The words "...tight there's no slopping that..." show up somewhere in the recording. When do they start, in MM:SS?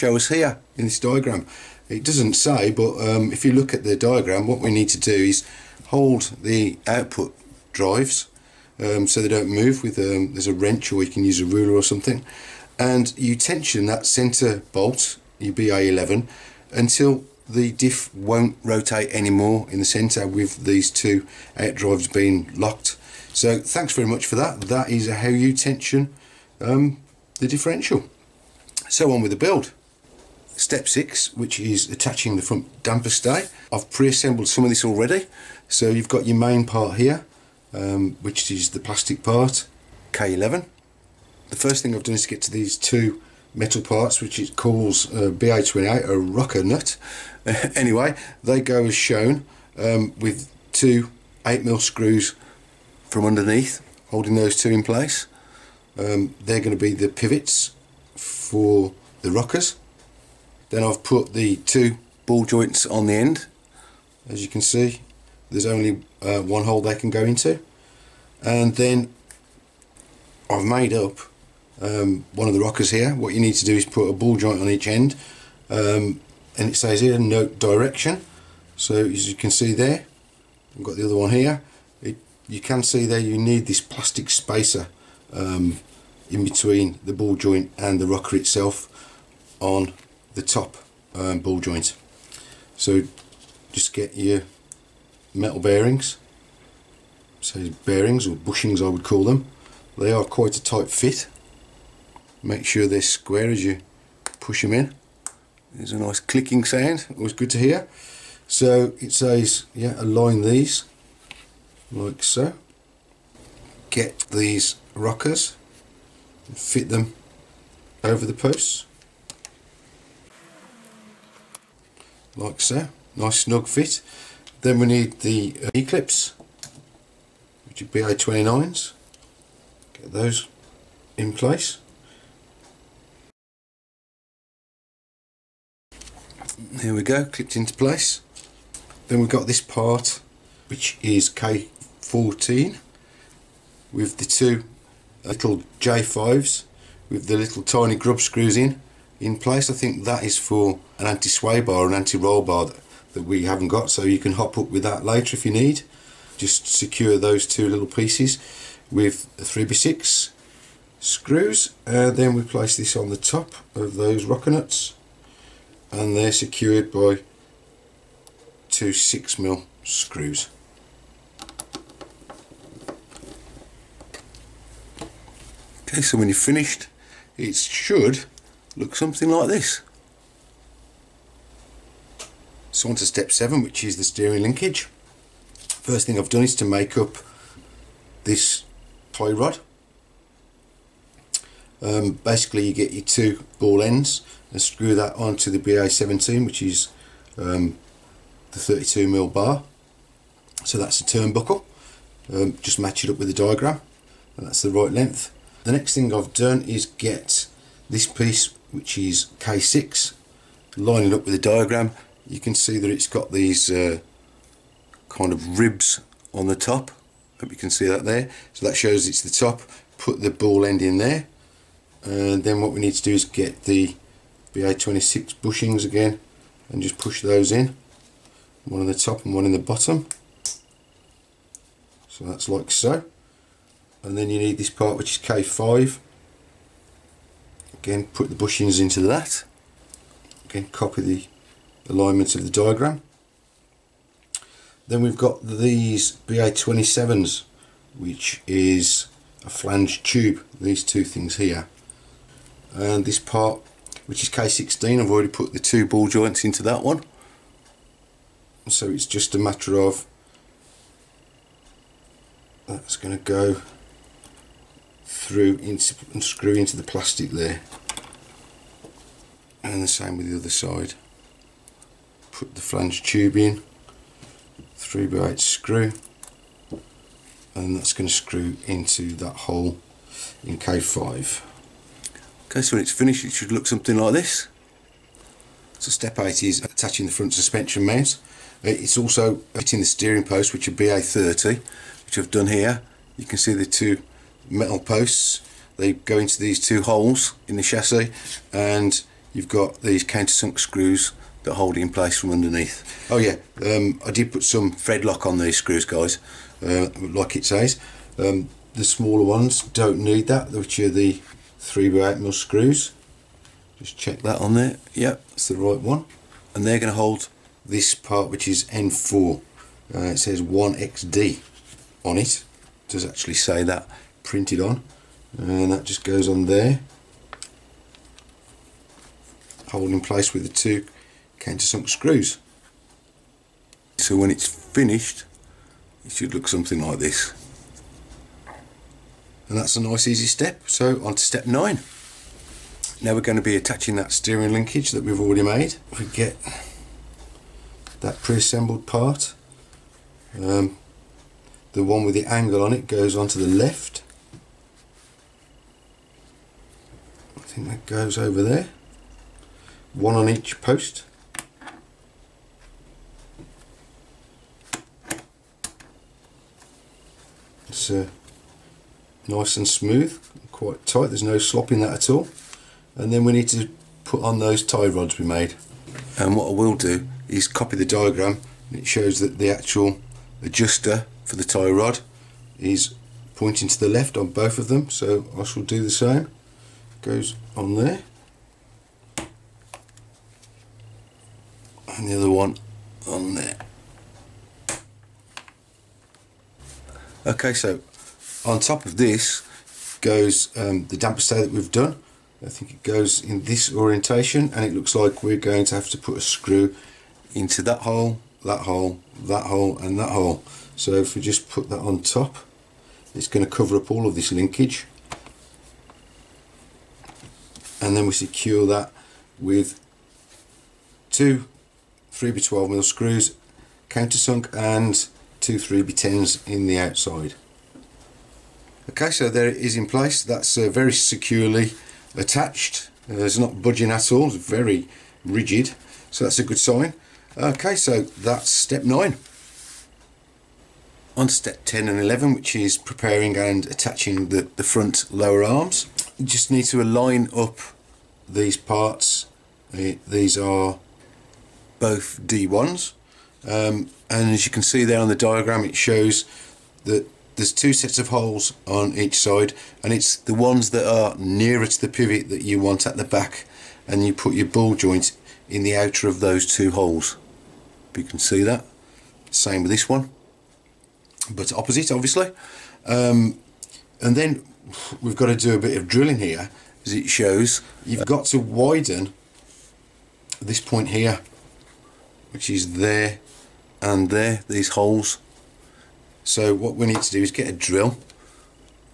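06:10.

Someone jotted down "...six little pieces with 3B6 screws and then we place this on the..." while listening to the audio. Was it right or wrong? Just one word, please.
wrong.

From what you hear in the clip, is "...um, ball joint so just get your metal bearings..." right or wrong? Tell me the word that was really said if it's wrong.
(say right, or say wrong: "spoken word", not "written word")
right.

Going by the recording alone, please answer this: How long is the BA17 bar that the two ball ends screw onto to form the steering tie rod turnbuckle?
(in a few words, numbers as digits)
32mm.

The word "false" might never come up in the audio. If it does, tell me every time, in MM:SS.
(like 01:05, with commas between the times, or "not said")
not said.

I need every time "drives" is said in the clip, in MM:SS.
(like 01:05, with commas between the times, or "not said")
00:07, 00:21.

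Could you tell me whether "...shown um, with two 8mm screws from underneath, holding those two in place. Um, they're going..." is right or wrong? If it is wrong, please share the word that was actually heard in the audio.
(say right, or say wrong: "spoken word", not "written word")
right.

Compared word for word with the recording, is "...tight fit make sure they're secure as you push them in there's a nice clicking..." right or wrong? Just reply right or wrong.
wrong.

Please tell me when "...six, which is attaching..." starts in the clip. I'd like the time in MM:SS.
00:30.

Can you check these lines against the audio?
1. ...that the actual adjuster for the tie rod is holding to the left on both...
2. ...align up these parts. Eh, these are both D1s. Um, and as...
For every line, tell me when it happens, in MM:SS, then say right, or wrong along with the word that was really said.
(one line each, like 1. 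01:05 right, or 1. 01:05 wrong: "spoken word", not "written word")
1. 06:19 wrong: "pointing", not "holding"
2. 07:26 right.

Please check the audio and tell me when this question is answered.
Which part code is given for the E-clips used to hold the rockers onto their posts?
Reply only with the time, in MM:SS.
02:07.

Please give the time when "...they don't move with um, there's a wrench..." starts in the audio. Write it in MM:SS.
00:09.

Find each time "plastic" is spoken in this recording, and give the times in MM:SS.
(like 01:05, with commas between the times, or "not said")
00:38, 01:23, 04:26.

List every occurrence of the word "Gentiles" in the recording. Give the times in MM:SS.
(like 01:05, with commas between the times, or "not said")
not said.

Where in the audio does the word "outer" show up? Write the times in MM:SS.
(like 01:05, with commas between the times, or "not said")
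07:45.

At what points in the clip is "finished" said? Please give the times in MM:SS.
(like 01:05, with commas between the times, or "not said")
02:56, 04:42, 05:34.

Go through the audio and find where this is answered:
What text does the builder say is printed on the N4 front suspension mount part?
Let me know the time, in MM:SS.
05:20.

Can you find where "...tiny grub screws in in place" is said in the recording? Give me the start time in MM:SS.
02:27.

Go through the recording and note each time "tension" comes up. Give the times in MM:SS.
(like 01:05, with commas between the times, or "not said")
00:13, 00:25.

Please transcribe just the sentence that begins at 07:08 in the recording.
Okay, so there it is in place.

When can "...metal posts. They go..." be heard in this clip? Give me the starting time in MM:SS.
04:54.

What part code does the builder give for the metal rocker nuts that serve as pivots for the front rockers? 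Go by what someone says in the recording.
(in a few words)
BA28.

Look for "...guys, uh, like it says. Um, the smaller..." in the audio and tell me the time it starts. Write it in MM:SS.
05:05.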